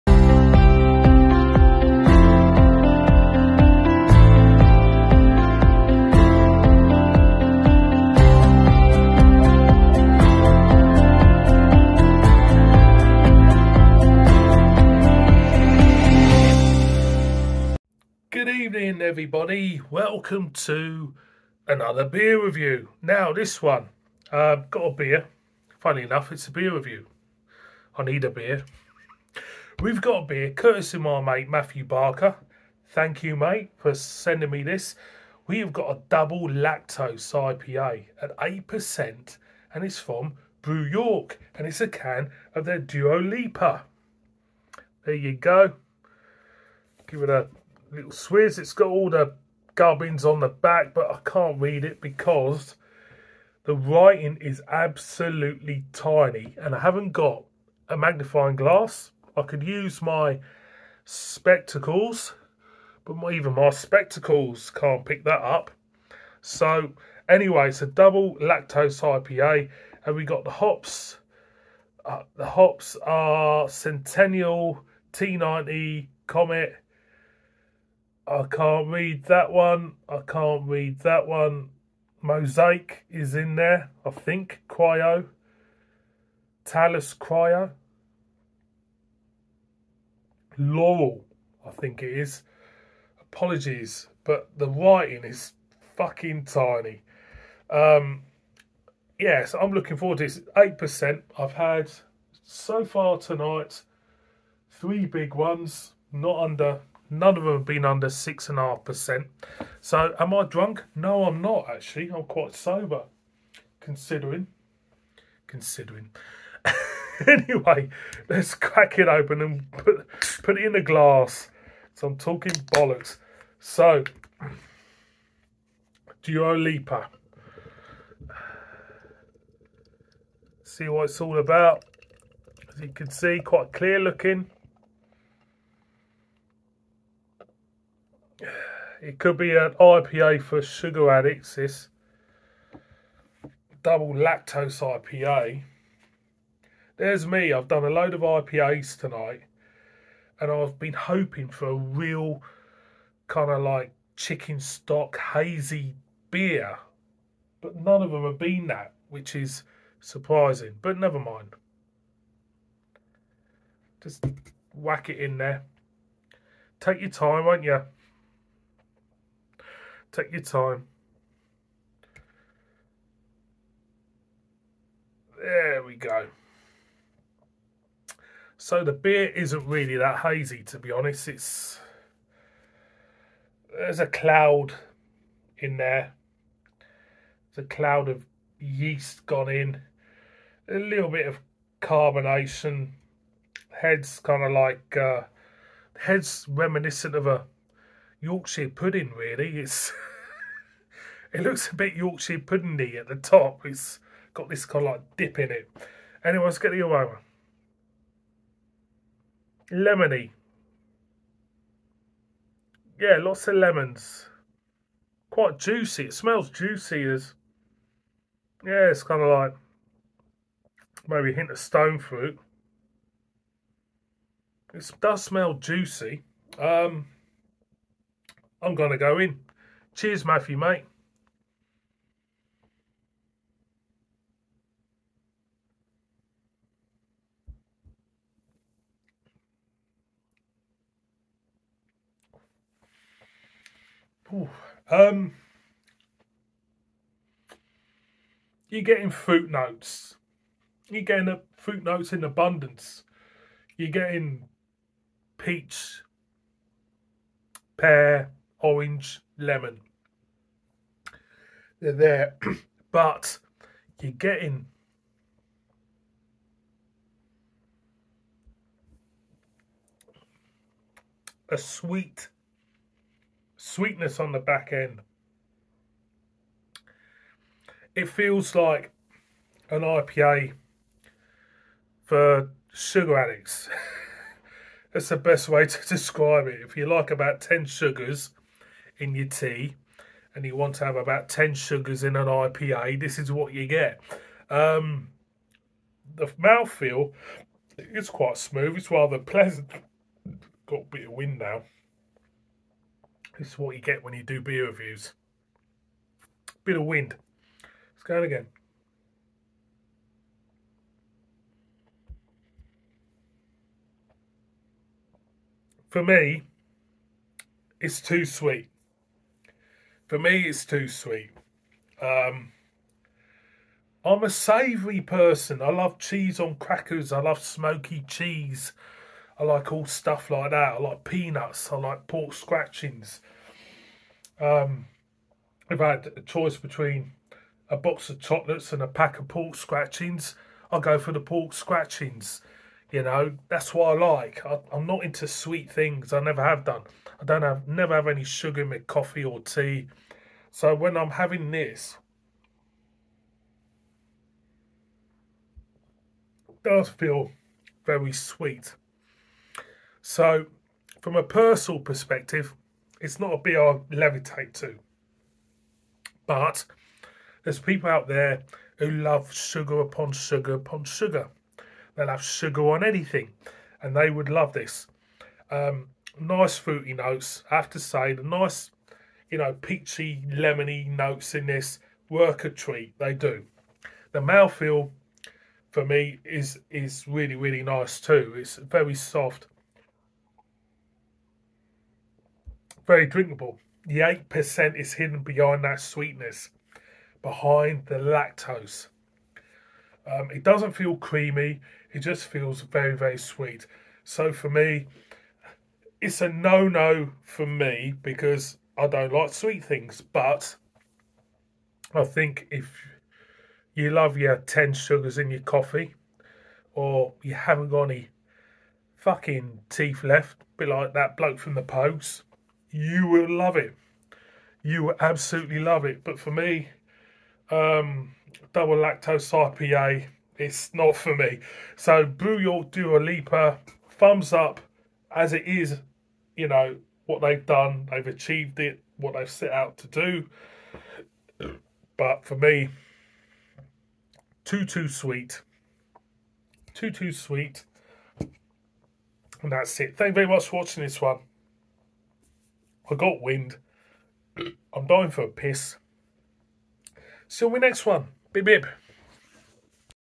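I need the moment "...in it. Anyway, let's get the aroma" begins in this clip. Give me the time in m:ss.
3:25.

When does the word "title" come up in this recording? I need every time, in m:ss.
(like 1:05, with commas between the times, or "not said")
not said.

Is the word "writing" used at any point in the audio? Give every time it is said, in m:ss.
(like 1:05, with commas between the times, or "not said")
0:53, 1:34.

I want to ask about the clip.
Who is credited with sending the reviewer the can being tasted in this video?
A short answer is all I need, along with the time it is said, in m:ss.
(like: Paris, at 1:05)
Matthew Barker, at 0:31.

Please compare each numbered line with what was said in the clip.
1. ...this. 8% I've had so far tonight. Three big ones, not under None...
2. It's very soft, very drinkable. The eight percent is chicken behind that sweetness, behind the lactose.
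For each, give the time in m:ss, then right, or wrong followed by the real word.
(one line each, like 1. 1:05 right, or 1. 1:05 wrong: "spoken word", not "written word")
1. 1:40 right
2. 6:28 wrong: "hidden", not "chicken".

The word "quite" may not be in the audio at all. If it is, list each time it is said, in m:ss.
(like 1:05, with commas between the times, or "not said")
1:52, 2:13, 3:35, 4:58.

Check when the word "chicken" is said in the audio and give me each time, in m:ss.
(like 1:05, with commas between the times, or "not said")
2:34.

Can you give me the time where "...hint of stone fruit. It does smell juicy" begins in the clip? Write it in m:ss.
3:41.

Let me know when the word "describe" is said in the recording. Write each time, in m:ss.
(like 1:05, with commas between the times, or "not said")
4:45.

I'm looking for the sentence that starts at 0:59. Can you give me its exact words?
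I could use my spectacles, but my, even my spectacles can't pick that up.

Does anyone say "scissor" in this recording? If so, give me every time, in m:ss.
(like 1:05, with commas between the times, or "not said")
not said.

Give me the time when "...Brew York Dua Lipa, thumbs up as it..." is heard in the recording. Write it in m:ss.
7:12.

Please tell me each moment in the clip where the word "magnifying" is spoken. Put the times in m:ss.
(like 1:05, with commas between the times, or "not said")
0:57.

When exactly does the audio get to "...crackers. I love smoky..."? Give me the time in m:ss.
5:26.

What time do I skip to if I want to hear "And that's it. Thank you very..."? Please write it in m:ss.
7:29.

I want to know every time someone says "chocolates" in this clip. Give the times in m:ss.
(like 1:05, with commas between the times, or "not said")
5:38.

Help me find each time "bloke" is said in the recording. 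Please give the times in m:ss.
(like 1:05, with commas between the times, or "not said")
7:01.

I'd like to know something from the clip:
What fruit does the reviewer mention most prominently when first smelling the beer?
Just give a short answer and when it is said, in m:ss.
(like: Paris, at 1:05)
Lemons, at 3:33.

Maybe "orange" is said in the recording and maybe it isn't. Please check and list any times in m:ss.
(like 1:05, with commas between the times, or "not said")
4:18.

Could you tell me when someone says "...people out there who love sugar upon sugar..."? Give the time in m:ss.
6:07.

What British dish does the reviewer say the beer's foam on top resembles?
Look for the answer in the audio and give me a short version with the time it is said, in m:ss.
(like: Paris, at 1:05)
Yorkshire pudding, at 3:18.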